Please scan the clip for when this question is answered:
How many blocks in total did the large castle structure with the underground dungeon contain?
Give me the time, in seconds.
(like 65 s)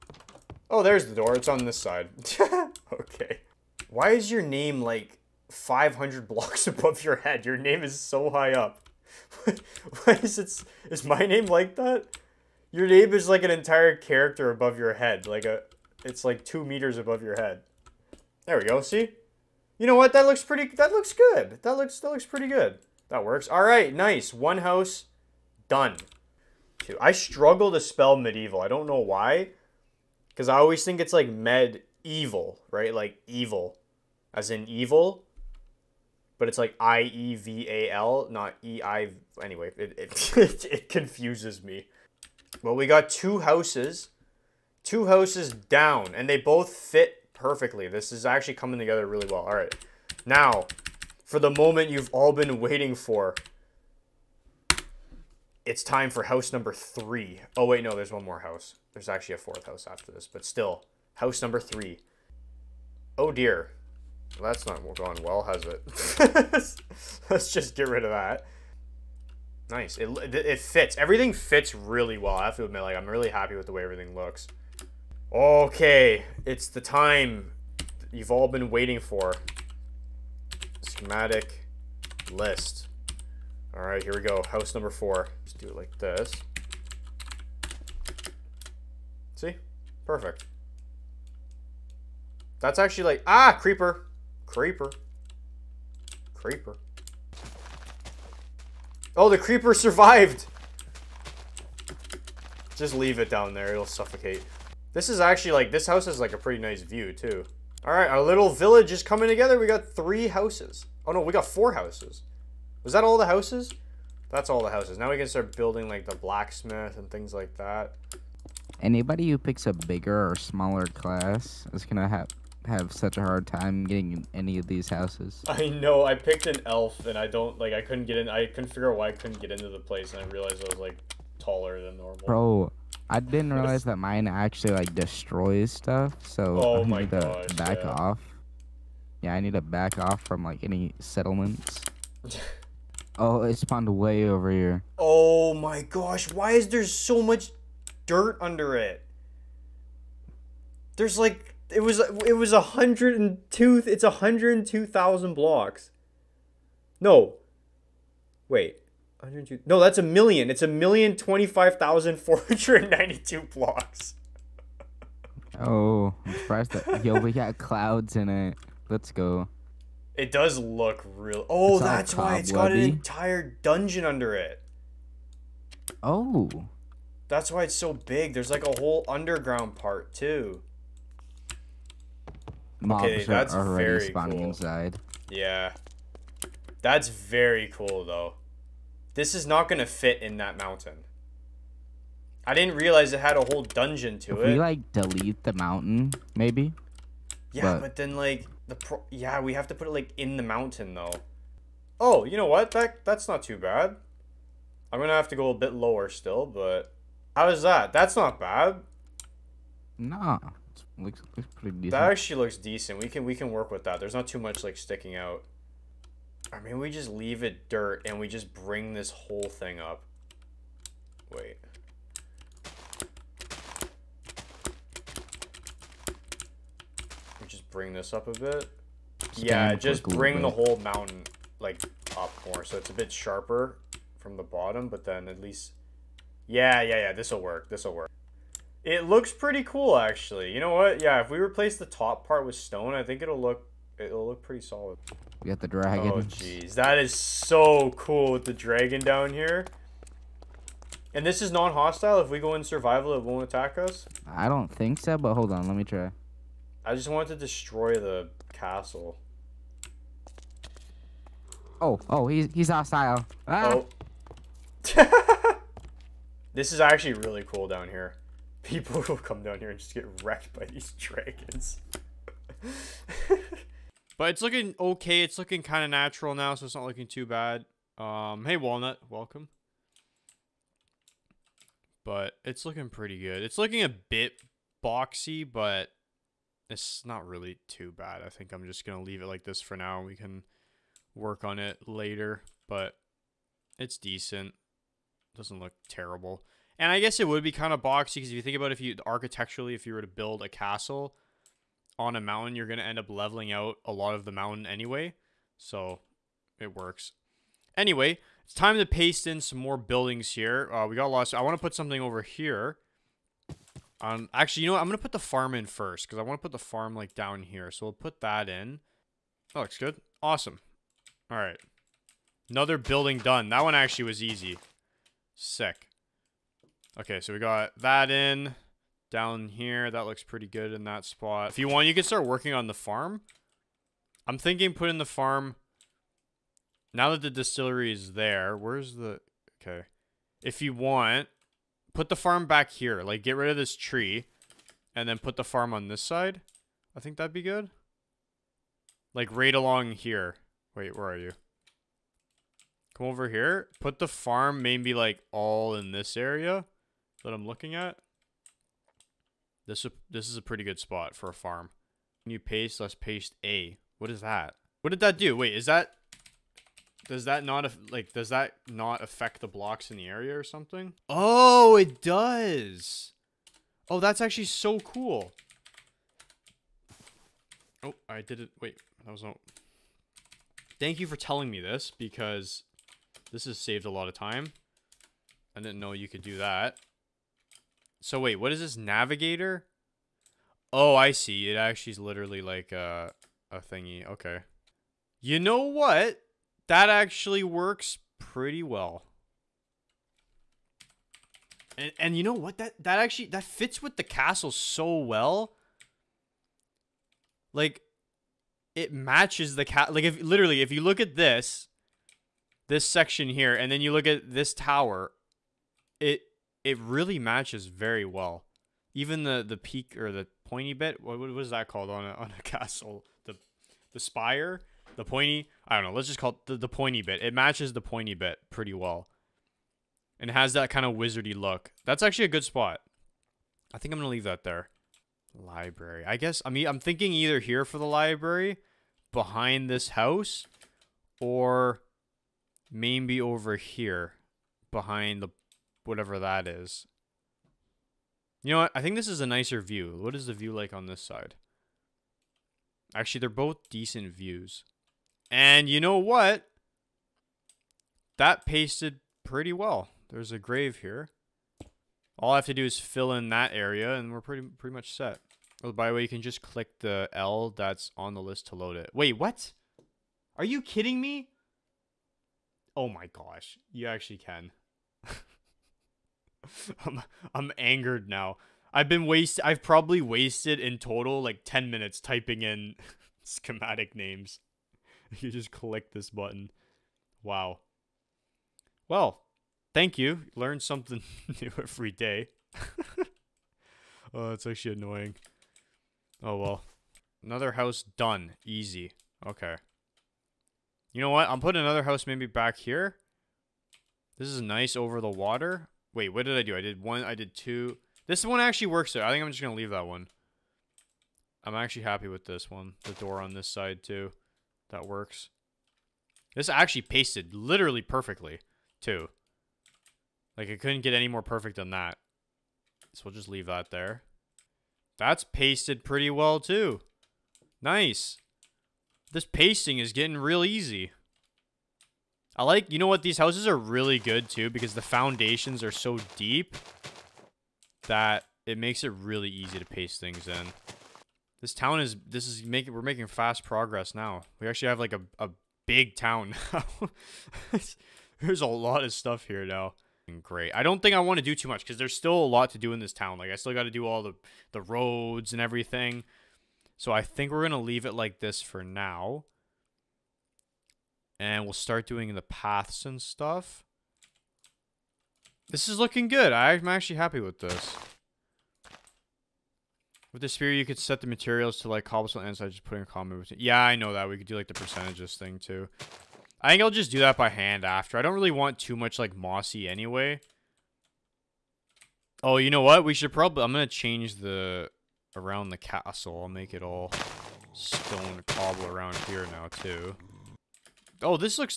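160 s.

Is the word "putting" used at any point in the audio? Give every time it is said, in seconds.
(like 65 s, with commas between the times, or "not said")
334 s, 501 s.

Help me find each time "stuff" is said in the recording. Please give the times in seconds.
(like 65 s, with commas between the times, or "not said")
135 s, 548 s, 563 s.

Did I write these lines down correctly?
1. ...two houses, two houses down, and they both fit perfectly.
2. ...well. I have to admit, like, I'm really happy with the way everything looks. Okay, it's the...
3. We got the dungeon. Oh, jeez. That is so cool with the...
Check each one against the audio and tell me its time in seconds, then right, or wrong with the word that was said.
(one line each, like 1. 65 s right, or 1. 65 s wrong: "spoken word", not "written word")
1. 43 s right
2. 72 s right
3. 245 s wrong: "dragon", not "dungeon".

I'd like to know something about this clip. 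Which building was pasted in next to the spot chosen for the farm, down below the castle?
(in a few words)
distillery.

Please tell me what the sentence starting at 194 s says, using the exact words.
we, like, delete the mountain, maybe?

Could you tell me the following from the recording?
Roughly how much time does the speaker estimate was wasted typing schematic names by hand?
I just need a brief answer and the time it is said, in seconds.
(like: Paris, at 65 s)
10 minutes, at 481 s.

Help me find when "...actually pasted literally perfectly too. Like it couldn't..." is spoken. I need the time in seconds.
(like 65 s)
516 s.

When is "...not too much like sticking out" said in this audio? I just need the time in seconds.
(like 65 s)
214 s.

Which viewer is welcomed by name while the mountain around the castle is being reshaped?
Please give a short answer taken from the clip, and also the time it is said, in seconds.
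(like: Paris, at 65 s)
Walnut, at 278 s.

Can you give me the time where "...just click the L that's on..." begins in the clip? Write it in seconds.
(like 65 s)
466 s.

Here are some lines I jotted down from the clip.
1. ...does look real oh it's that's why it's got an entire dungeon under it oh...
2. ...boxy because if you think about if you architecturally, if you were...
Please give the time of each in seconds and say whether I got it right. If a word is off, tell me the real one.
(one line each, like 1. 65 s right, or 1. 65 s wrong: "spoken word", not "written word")
1. 170 s right
2. 297 s right.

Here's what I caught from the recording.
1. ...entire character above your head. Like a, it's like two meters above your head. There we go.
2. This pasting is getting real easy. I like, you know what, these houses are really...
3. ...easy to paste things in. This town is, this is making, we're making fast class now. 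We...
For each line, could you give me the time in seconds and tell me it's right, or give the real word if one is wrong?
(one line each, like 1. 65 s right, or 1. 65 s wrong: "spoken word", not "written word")
1. 13 s right
2. 529 s right
3. 539 s wrong: "progress", not "class".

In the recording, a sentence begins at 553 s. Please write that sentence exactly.
Like I still got to do all the, the roads and everything.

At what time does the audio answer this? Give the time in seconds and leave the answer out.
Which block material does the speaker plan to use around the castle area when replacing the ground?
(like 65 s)
587 s.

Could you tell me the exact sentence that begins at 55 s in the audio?
It's time for house number three.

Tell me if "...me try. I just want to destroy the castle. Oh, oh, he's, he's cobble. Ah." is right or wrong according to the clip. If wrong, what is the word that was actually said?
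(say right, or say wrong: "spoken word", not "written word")
wrong: "hostile", not "cobble".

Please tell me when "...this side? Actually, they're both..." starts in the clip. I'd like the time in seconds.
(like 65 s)
450 s.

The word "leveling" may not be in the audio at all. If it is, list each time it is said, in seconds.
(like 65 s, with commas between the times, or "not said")
303 s.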